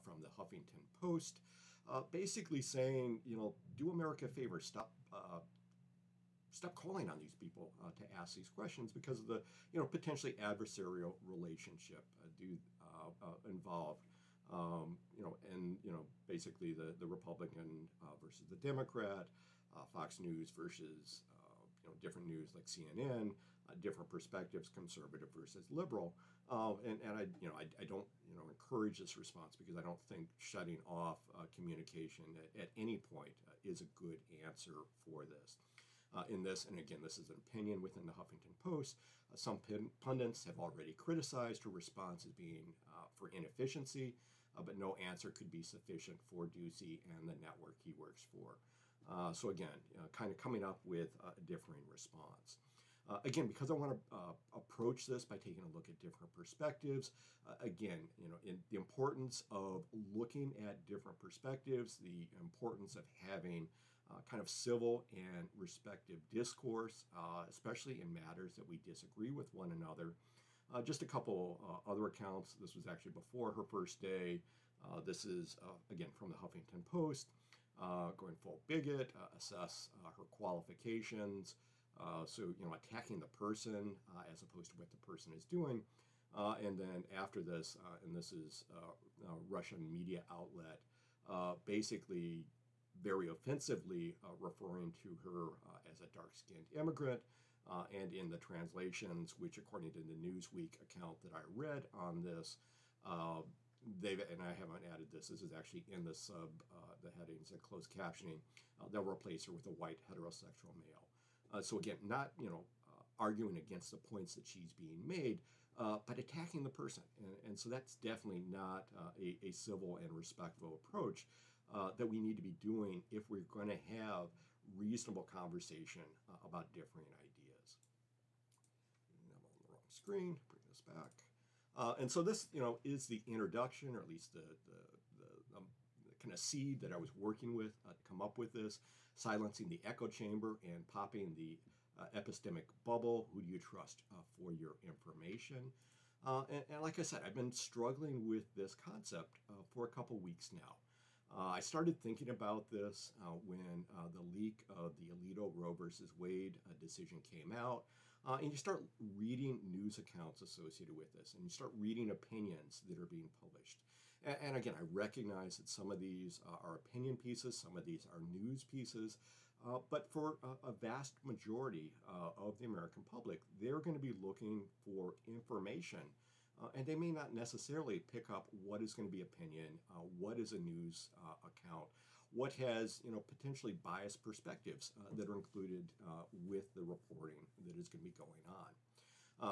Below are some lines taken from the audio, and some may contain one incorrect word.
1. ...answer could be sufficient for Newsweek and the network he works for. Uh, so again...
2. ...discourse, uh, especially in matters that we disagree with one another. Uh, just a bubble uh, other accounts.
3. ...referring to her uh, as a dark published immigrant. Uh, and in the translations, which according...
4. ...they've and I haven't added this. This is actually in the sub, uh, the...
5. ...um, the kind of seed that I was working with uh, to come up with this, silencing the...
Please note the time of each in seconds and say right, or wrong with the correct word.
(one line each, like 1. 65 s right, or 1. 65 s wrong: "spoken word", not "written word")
1. 44 s wrong: "Doocy", not "Newsweek"
2. 66 s wrong: "couple", not "bubble"
3. 94 s wrong: "skinned", not "published"
4. 103 s right
5. 135 s right.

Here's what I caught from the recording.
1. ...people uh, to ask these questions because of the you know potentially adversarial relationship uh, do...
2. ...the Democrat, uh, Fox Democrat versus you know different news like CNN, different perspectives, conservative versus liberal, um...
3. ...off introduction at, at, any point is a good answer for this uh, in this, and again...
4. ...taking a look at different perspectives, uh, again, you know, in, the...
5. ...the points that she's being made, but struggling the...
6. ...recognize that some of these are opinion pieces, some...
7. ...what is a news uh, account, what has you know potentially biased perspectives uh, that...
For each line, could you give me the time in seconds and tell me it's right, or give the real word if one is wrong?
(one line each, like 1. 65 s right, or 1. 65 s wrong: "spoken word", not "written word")
1. 7 s right
2. 18 s wrong: "News", not "Democrat"
3. 30 s wrong: "communication", not "introduction"
4. 55 s right
5. 113 s wrong: "attacking", not "struggling"
6. 164 s right
7. 180 s right.